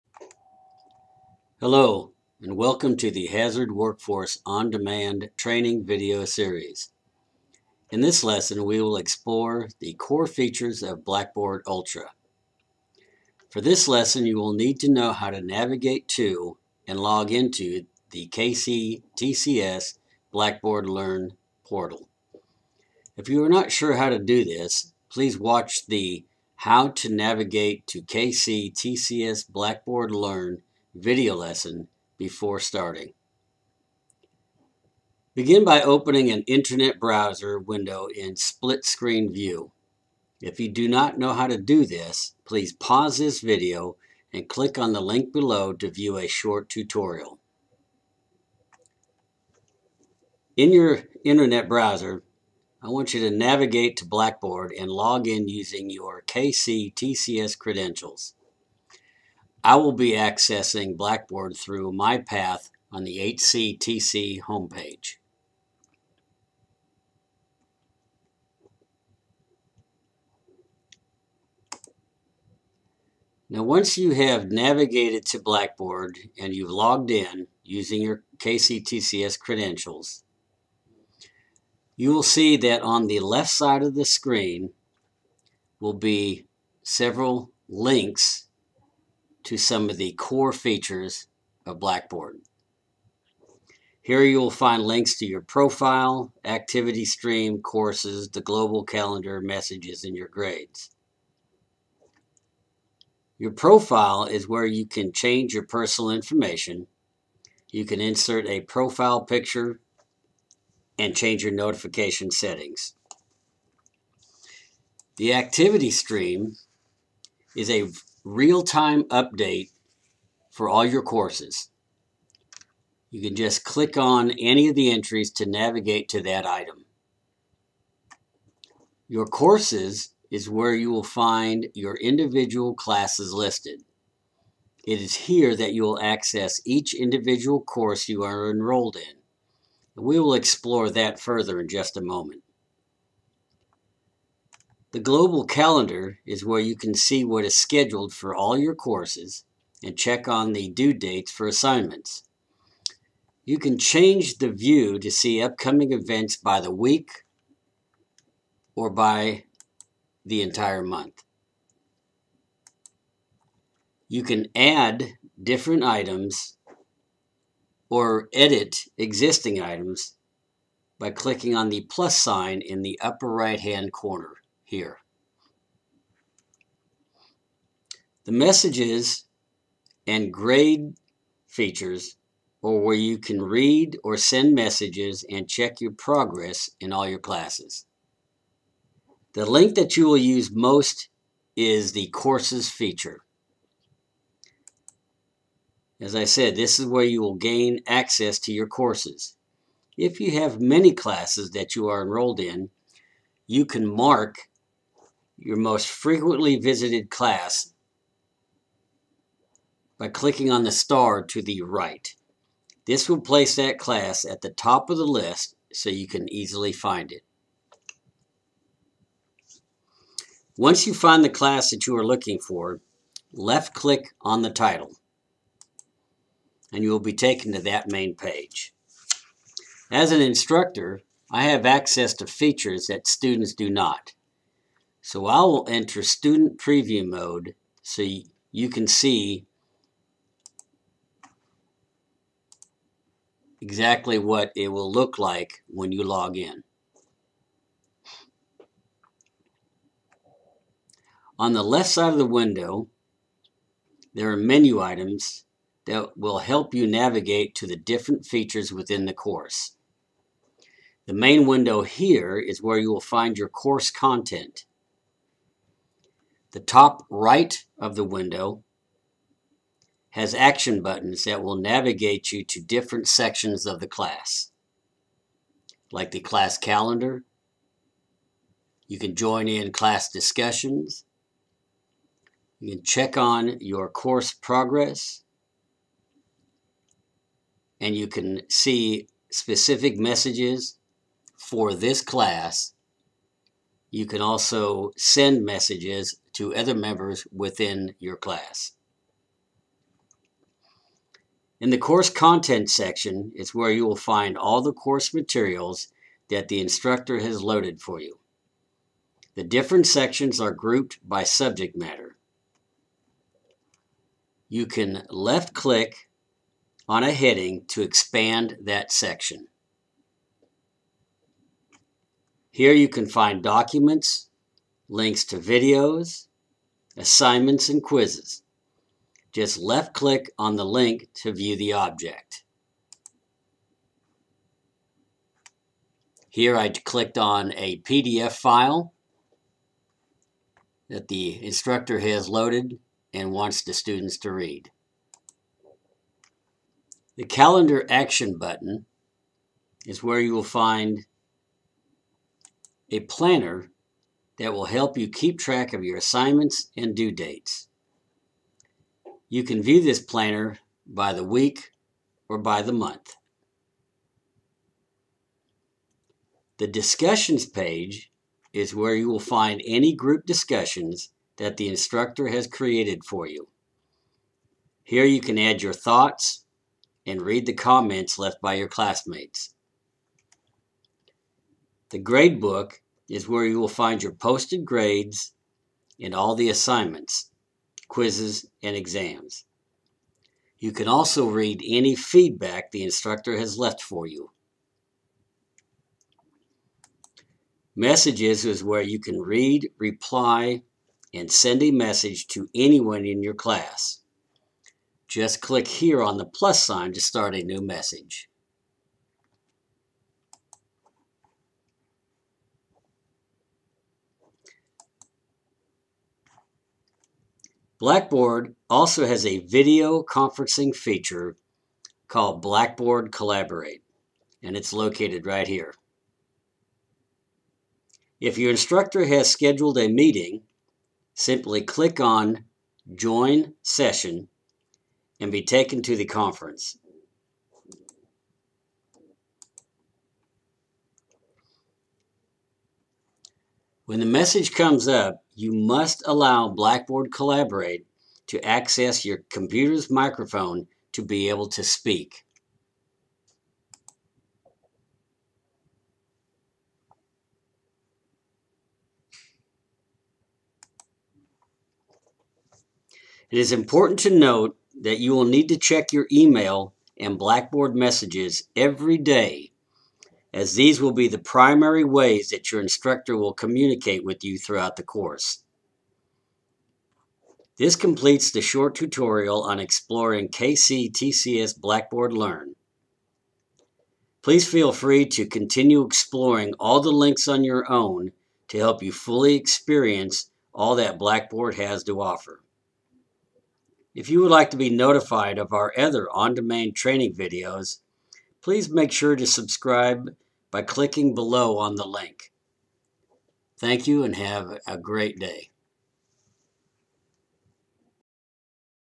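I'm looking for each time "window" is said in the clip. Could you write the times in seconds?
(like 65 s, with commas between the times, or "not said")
37 s, 252 s, 261 s, 268 s.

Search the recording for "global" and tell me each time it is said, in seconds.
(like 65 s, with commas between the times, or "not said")
98 s, 144 s.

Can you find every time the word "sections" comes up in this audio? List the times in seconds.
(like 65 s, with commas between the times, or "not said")
273 s, 302 s, 309 s, 318 s.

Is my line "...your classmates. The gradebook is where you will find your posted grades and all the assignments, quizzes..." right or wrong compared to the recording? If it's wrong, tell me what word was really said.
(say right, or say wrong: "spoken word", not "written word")
right.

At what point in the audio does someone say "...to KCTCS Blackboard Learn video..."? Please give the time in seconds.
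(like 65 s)
27 s.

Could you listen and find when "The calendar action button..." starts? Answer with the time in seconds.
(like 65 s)
347 s.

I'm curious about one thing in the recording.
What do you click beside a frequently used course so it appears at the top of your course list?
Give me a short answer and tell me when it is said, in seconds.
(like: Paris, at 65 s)
the star, at 210 s.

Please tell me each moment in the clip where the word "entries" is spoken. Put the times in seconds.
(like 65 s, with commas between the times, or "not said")
124 s.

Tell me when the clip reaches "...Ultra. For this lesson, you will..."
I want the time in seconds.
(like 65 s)
11 s.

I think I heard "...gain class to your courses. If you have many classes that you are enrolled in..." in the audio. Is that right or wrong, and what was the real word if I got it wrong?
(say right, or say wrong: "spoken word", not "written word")
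wrong: "access", not "class".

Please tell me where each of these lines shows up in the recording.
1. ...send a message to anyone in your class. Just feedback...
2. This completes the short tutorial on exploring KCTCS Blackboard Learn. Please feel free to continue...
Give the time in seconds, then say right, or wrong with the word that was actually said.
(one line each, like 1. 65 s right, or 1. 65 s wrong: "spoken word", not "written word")
1. 401 s wrong: "click", not "feedback"
2. 477 s right.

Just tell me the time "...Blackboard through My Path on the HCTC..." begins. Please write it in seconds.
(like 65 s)
60 s.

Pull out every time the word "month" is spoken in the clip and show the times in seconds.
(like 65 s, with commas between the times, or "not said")
160 s, 362 s.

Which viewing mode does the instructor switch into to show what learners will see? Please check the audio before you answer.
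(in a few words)
student preview mode.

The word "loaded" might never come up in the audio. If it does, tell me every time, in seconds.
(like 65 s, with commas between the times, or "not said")
307 s, 342 s.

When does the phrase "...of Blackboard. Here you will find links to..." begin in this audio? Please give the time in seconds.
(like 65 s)
91 s.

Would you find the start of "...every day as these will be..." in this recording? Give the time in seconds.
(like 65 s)
468 s.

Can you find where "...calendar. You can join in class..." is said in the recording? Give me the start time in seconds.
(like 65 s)
276 s.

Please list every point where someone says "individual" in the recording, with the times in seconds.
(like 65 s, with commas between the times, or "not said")
131 s, 136 s.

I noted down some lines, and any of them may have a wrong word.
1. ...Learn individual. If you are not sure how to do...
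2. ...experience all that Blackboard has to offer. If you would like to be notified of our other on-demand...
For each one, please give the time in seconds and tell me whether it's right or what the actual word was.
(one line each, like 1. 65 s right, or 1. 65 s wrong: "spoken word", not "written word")
1. 20 s wrong: "portal", not "individual"
2. 489 s right.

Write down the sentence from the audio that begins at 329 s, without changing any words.
Just left click on the link to view the object.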